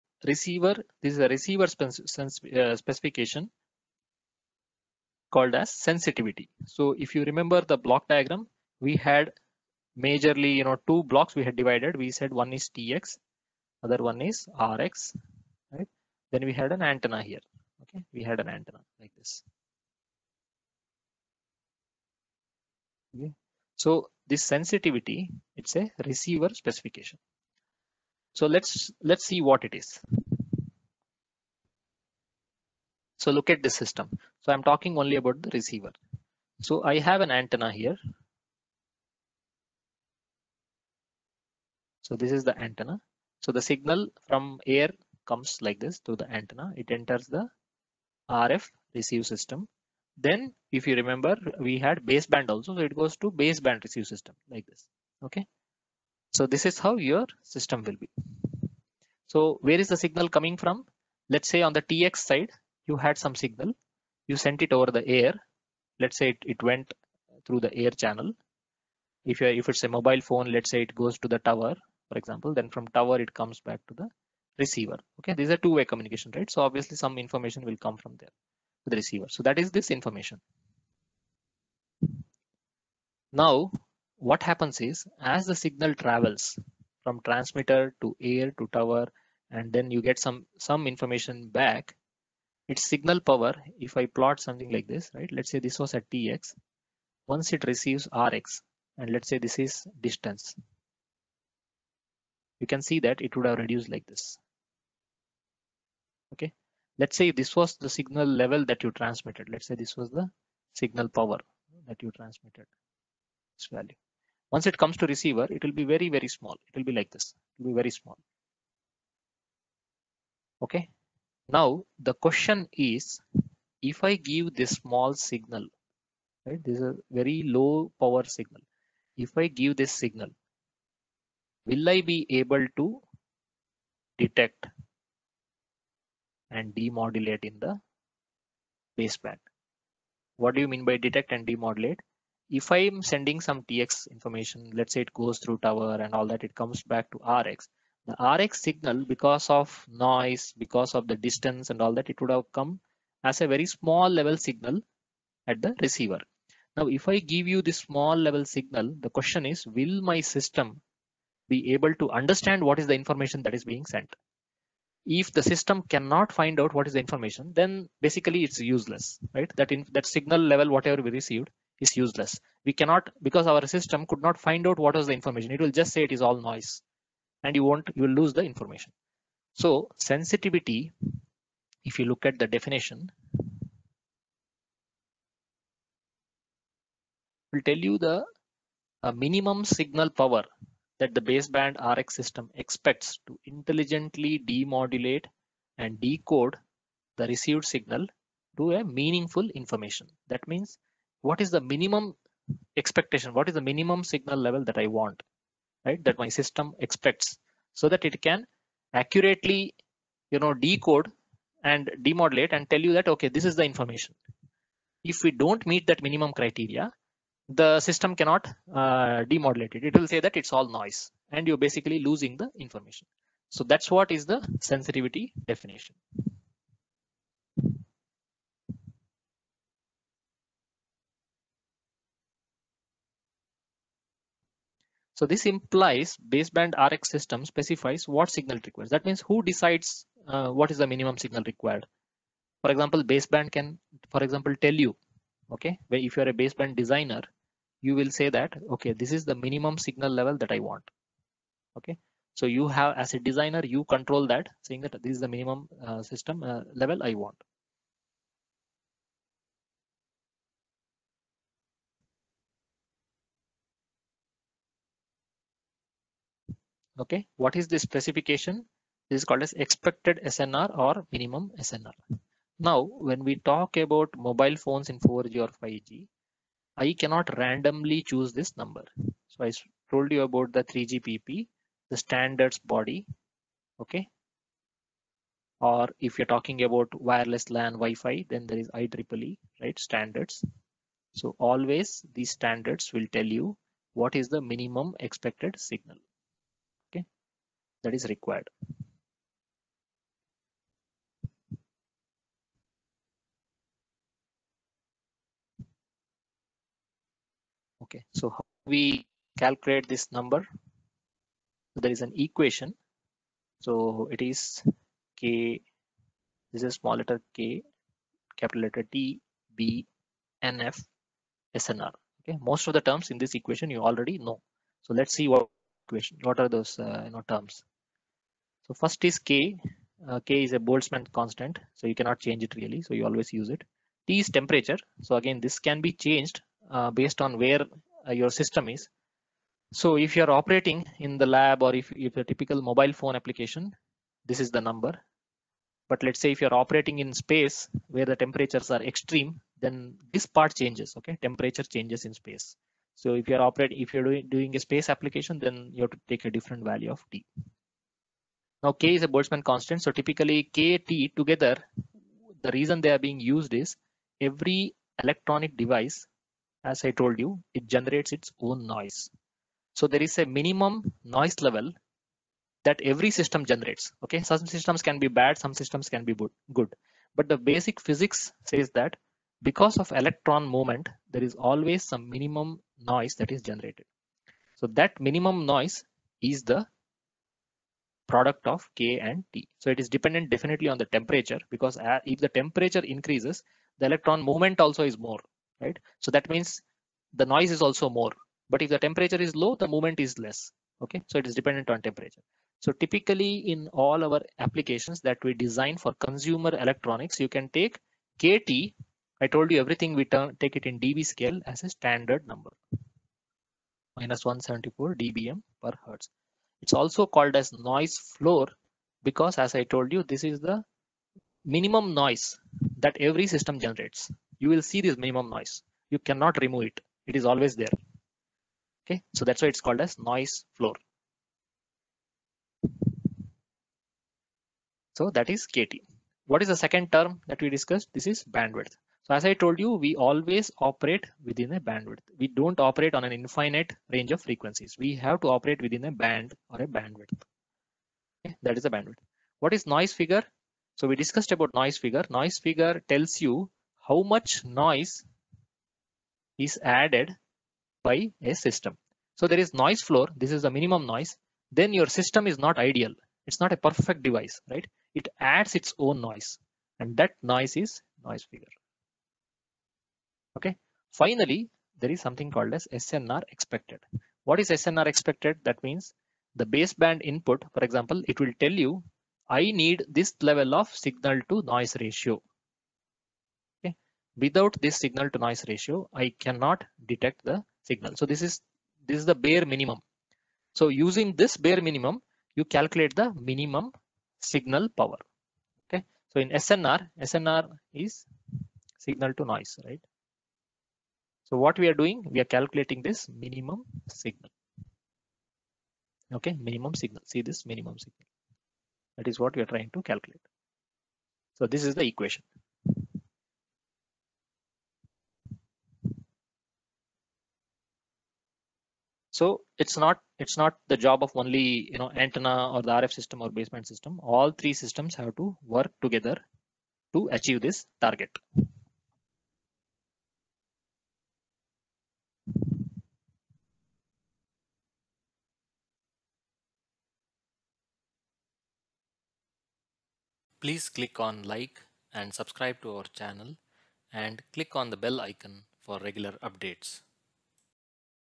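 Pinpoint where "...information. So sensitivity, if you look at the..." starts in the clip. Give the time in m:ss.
2:58.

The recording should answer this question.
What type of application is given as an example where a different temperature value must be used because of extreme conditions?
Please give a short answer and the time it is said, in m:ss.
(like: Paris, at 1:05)
Space application, at 5:54.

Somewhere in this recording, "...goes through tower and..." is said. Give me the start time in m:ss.
2:25.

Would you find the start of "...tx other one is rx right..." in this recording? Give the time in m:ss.
0:12.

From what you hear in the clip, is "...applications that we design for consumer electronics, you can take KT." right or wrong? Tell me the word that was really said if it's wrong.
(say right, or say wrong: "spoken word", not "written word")
right.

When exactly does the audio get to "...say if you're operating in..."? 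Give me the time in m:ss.
5:46.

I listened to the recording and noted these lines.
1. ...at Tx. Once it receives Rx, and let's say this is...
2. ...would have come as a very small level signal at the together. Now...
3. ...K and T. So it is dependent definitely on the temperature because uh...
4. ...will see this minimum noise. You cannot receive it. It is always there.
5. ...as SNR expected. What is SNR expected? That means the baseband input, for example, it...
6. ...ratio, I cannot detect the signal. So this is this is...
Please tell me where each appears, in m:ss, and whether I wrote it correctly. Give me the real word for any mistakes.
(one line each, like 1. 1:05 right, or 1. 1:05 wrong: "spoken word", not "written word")
1. 1:35 right
2. 2:32 wrong: "receiver", not "together"
3. 6:28 right
4. 7:04 wrong: "remove", not "receive"
5. 7:52 right
6. 8:05 right.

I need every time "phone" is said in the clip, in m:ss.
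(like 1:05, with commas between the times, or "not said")
1:10, 4:34, 5:42.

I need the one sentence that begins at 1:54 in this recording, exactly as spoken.
Once it comes to receiver, it will be very, very small.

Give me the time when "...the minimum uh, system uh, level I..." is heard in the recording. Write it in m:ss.
4:15.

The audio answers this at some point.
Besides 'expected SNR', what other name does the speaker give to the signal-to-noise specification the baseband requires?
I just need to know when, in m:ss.
4:31.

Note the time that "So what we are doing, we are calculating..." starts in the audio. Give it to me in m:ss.
8:21.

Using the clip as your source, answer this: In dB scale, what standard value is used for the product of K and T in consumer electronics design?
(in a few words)
-174 dBm per hertz.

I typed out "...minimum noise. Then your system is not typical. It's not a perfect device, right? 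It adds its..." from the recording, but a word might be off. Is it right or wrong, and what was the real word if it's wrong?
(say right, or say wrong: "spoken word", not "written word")
wrong: "ideal", not "typical".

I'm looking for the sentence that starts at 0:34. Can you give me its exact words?
So I'm talking only about the receiver.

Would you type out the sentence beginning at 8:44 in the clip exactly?
All three systems have to work together to achieve this target.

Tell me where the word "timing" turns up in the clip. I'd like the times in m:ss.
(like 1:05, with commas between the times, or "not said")
not said.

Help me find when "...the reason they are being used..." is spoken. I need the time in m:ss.
6:02.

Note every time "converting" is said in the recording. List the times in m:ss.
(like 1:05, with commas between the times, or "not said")
not said.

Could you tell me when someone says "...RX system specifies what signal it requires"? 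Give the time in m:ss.
3:56.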